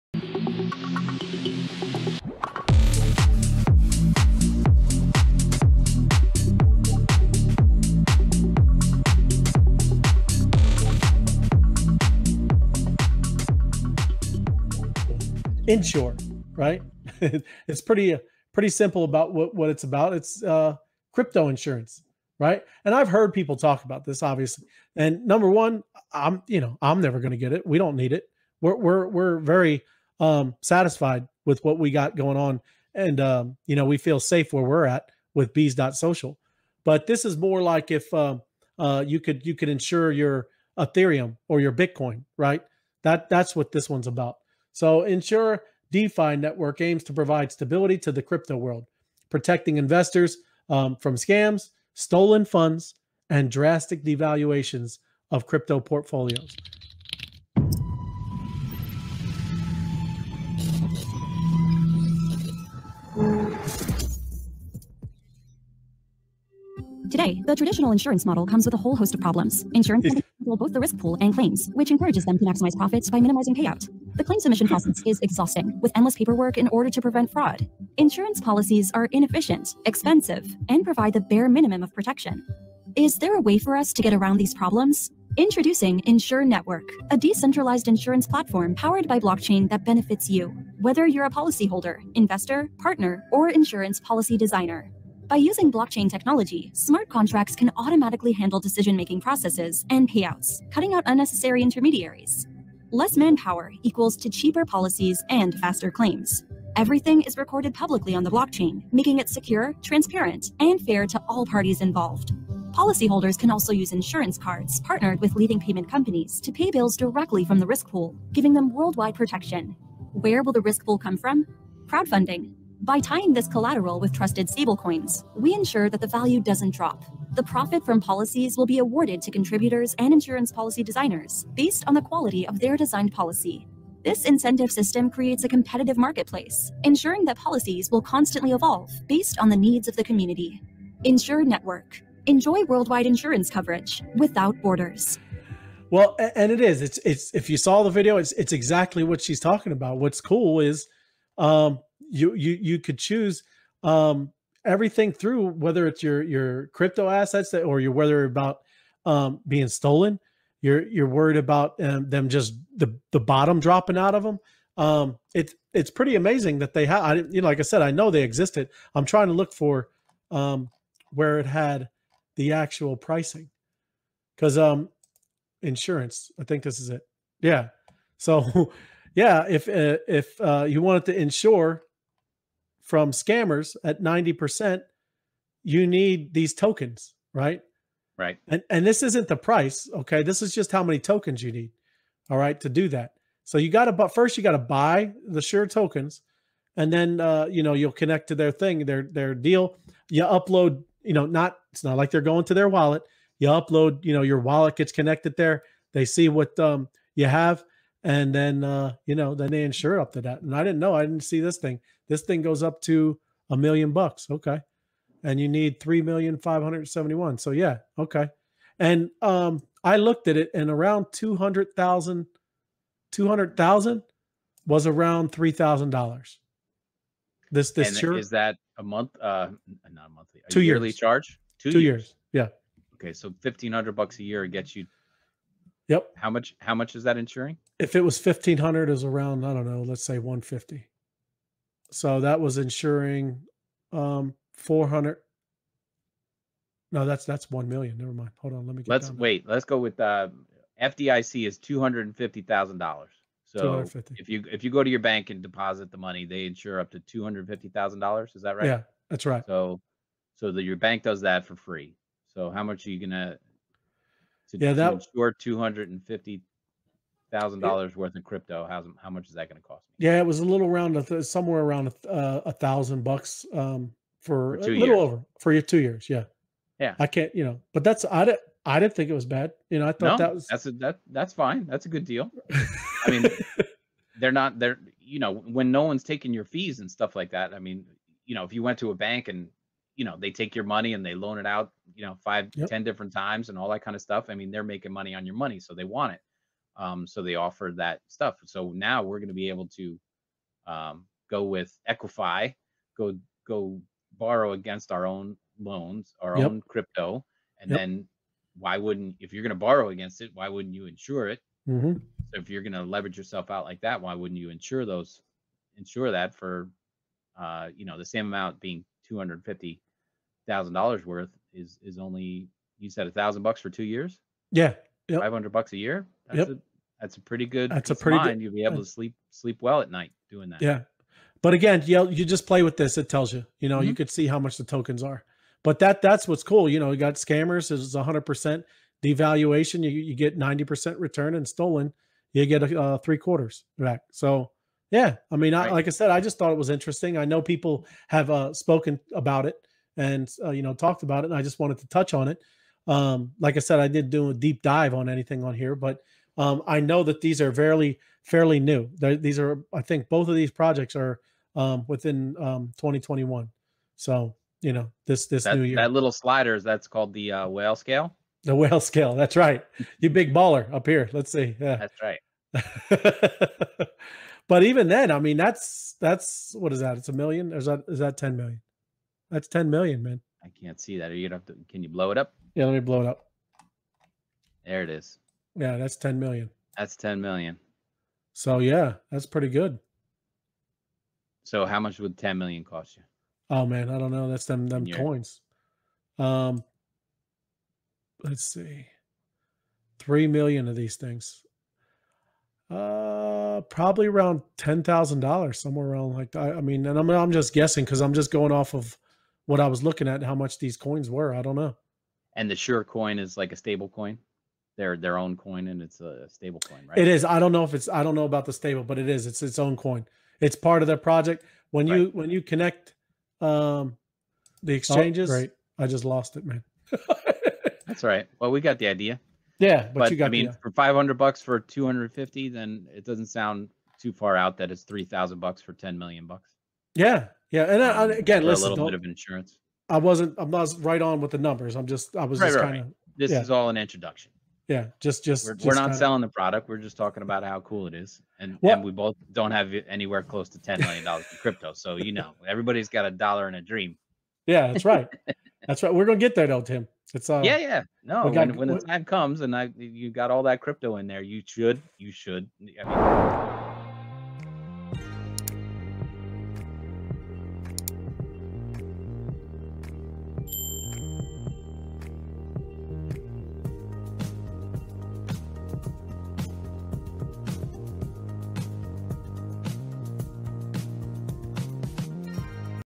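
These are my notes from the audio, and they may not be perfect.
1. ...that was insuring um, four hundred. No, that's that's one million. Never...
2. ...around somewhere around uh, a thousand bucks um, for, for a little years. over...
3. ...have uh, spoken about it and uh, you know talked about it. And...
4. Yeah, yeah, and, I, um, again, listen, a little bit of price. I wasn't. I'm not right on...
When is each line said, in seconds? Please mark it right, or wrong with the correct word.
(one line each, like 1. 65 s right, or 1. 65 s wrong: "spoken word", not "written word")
1. 242 s right
2. 270 s right
3. 348 s right
4. 436 s wrong: "insurance", not "price".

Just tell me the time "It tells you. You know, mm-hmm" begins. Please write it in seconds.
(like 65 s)
332 s.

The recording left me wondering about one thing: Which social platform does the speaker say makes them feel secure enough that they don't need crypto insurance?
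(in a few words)
bees.social.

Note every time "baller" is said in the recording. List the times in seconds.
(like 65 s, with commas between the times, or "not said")
370 s.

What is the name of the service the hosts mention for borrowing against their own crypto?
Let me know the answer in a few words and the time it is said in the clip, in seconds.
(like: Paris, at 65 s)
Equify, at 301 s.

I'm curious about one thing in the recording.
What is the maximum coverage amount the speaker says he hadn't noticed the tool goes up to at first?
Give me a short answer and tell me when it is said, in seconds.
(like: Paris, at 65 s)
a million bucks, at 213 s.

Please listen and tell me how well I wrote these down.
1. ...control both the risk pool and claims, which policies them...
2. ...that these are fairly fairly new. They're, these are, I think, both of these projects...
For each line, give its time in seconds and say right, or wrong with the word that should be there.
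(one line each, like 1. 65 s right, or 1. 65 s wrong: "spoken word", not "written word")
1. 70 s wrong: "encourages", not "policies"
2. 357 s right.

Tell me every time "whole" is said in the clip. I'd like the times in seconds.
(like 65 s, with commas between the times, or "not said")
68 s.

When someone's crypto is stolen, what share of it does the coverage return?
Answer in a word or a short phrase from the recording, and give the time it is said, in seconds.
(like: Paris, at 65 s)
three quarters, at 342 s.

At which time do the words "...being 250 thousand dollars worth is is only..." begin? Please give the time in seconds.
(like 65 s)
318 s.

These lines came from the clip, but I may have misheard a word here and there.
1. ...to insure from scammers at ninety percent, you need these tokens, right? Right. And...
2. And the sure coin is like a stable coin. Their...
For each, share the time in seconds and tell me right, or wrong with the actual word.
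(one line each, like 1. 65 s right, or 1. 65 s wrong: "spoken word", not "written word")
1. 181 s right
2. 412 s right.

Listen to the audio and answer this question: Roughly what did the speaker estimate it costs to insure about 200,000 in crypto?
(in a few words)
$3,000.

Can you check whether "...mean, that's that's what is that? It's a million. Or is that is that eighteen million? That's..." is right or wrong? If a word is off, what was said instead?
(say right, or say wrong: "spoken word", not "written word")
wrong: "ten", not "eighteen".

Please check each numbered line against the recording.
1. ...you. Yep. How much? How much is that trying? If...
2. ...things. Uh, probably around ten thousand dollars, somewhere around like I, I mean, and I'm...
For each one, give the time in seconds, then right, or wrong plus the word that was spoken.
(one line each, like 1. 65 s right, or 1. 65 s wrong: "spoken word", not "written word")
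1. 234 s wrong: "insuring", not "trying"
2. 400 s right.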